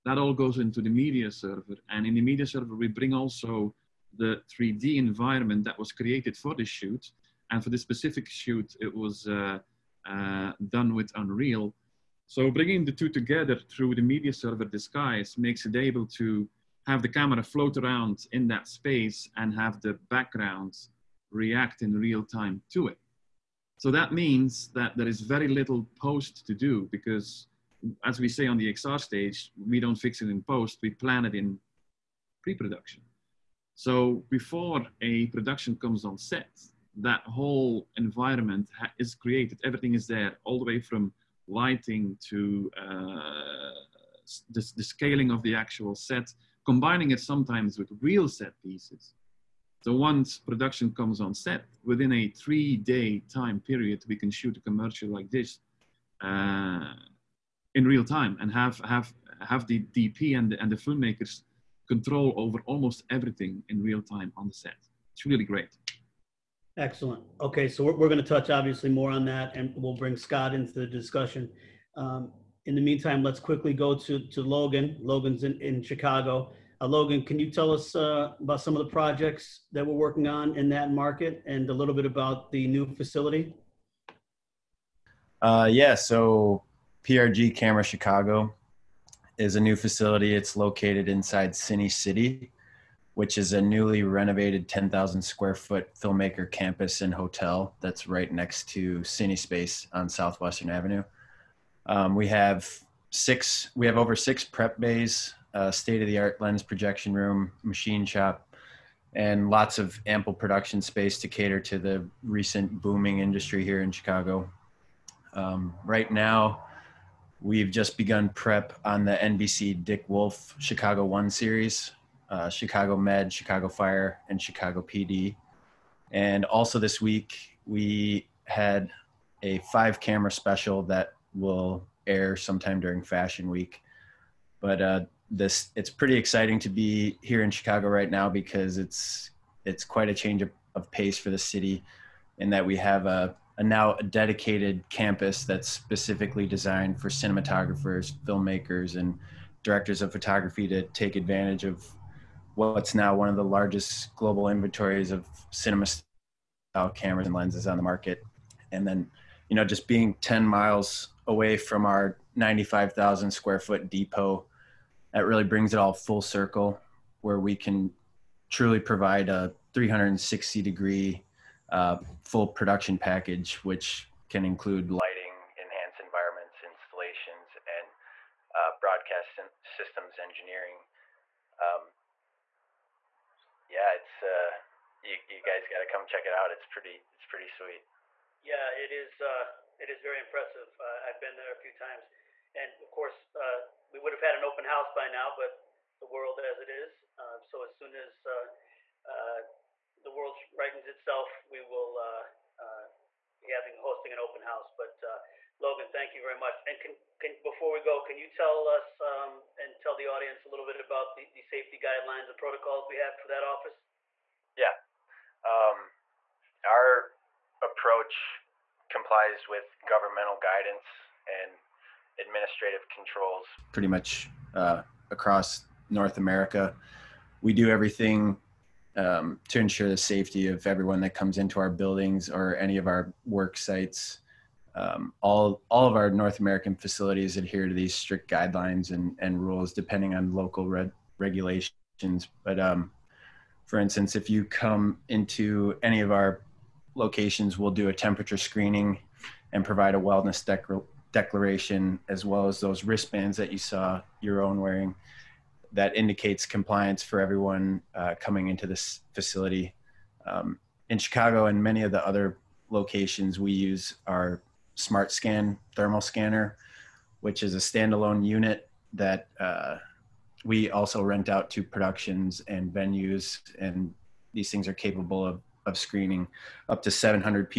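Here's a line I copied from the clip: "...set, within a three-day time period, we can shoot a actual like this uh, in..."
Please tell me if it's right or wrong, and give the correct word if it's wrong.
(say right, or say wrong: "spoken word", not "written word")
wrong: "commercial", not "actual".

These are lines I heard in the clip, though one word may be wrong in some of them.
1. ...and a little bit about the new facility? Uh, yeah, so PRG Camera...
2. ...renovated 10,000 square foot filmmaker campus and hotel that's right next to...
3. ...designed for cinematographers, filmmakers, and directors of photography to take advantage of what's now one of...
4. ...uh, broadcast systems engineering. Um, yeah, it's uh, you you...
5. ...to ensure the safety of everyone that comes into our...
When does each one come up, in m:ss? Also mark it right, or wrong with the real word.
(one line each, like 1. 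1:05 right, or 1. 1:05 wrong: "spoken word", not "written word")
1. 1:21 right
2. 1:34 right
3. 2:26 right
4. 2:58 right
5. 3:49 right.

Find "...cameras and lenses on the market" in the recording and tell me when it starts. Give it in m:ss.
2:36.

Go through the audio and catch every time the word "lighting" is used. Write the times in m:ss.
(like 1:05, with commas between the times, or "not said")
0:41, 2:54.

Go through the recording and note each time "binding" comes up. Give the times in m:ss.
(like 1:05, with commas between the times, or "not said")
not said.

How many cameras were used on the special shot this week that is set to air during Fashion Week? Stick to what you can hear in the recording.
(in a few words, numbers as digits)
5.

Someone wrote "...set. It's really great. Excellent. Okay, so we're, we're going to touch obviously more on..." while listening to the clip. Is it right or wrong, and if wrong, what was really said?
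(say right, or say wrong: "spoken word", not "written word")
right.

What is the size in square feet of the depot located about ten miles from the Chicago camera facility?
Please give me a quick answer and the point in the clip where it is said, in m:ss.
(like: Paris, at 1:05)
95,000, at 2:42.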